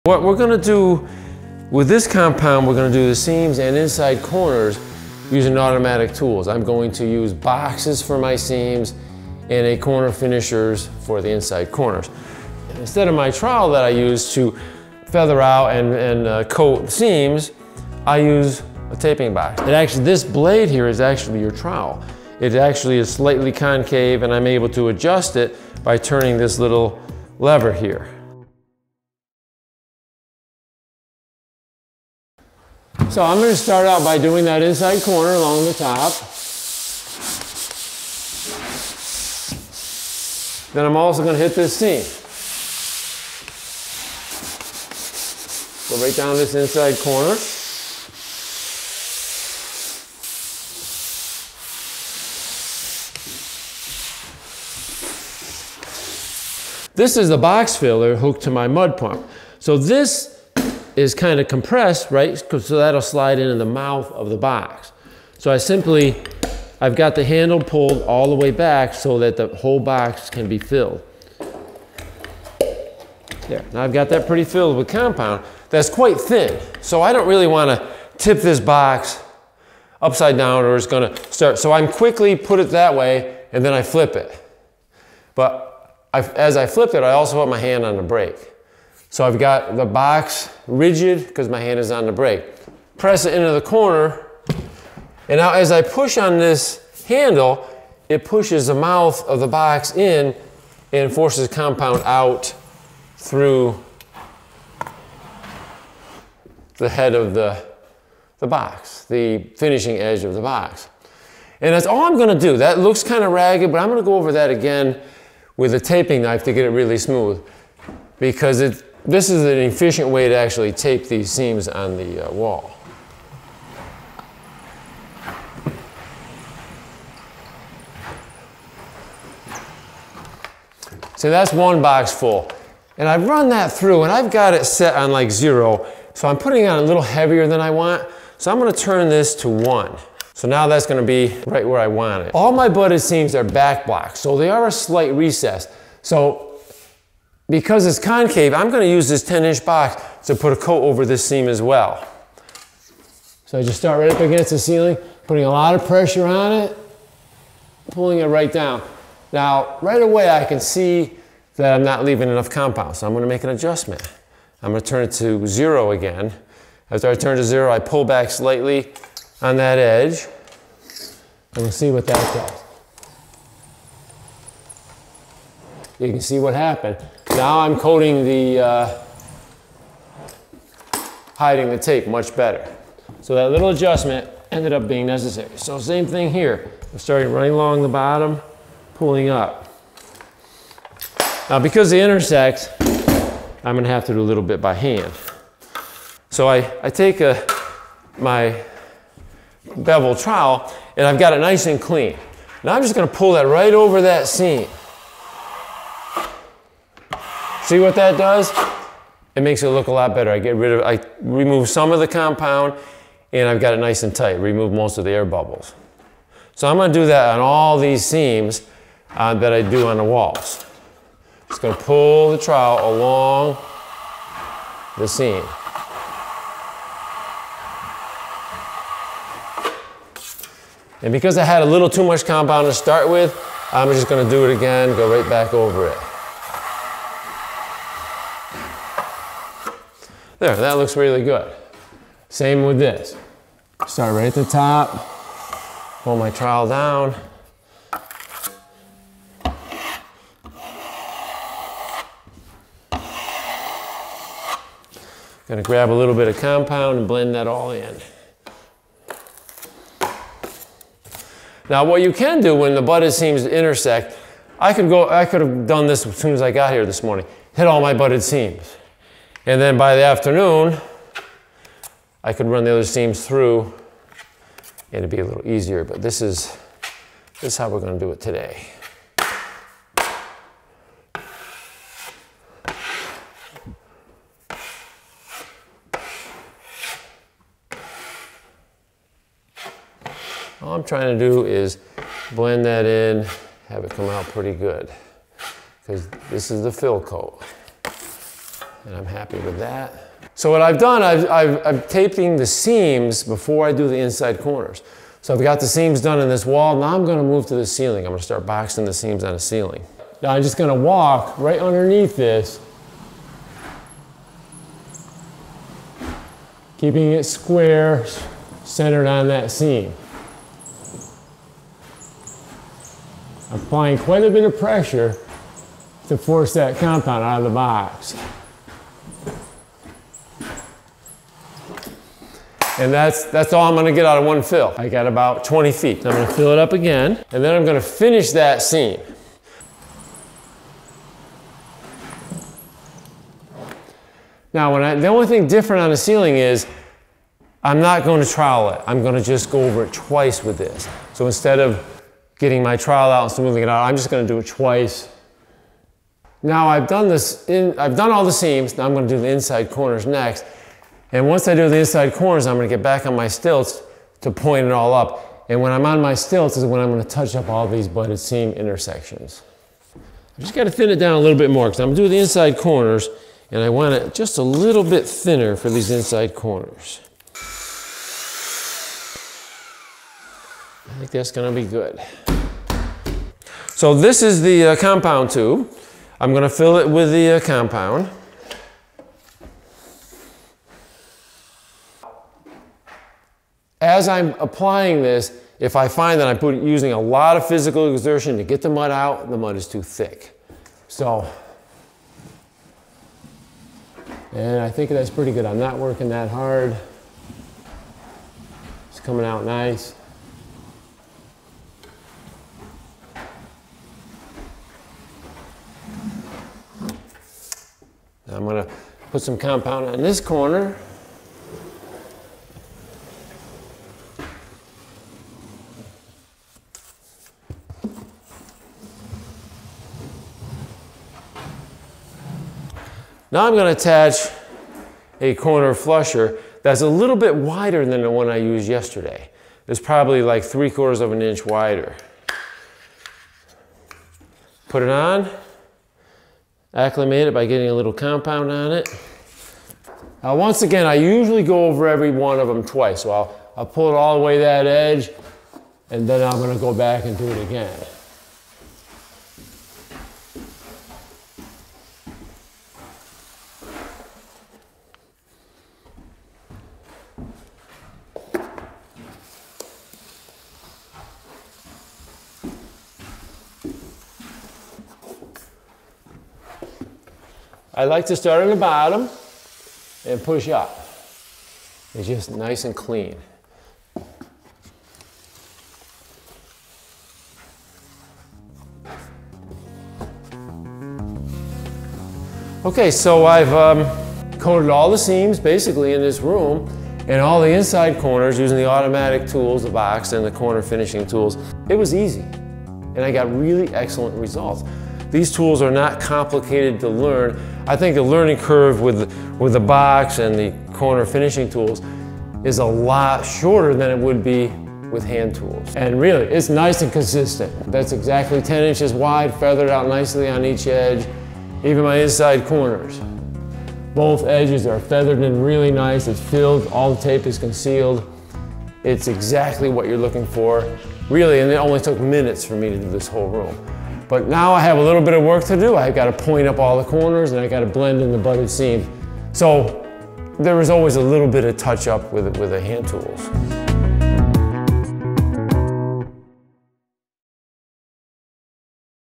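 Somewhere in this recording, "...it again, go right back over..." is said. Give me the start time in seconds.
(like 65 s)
234 s.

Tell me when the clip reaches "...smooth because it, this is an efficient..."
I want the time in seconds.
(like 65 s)
116 s.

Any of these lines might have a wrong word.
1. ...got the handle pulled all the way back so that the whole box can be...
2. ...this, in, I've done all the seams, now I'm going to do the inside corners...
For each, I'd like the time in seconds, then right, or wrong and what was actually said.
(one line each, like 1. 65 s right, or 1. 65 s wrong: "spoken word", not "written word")
1. 66 s right
2. 357 s right.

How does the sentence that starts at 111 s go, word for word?
And that's all I'm gonna do.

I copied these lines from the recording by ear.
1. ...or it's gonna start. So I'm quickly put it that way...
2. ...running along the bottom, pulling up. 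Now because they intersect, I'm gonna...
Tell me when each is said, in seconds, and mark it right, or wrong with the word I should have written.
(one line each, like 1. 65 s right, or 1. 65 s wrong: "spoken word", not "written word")
1. 80 s right
2. 187 s right.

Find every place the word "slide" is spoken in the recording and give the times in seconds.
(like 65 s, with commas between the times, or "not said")
63 s.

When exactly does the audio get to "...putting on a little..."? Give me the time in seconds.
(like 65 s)
136 s.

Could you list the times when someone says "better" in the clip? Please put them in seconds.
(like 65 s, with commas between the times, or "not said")
182 s, 210 s.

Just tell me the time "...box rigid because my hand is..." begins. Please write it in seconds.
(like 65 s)
89 s.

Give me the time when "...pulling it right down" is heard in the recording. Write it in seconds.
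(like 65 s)
157 s.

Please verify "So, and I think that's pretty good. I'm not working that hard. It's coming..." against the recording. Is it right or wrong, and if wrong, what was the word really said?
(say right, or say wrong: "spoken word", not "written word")
right.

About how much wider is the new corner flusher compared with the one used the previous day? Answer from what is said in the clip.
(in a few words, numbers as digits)
three quarters of an inch.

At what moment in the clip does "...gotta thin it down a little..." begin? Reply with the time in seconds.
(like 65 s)
370 s.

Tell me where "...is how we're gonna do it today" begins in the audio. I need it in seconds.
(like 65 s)
277 s.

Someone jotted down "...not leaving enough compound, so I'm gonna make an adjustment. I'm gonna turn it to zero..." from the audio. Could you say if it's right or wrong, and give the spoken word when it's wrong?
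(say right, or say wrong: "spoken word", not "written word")
right.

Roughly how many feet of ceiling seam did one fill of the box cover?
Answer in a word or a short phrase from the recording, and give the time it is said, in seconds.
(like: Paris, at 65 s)
20 feet, at 335 s.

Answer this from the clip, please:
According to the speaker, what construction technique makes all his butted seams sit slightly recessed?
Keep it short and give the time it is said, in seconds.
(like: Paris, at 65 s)
back blocks, at 143 s.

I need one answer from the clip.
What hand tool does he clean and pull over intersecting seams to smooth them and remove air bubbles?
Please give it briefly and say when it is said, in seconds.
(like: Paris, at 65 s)
bevel trowel, at 199 s.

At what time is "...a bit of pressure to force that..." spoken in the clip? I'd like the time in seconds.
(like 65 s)
324 s.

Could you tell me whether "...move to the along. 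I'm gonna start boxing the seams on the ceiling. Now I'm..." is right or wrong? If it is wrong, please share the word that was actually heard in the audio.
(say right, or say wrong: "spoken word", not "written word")
wrong: "ceiling", not "along".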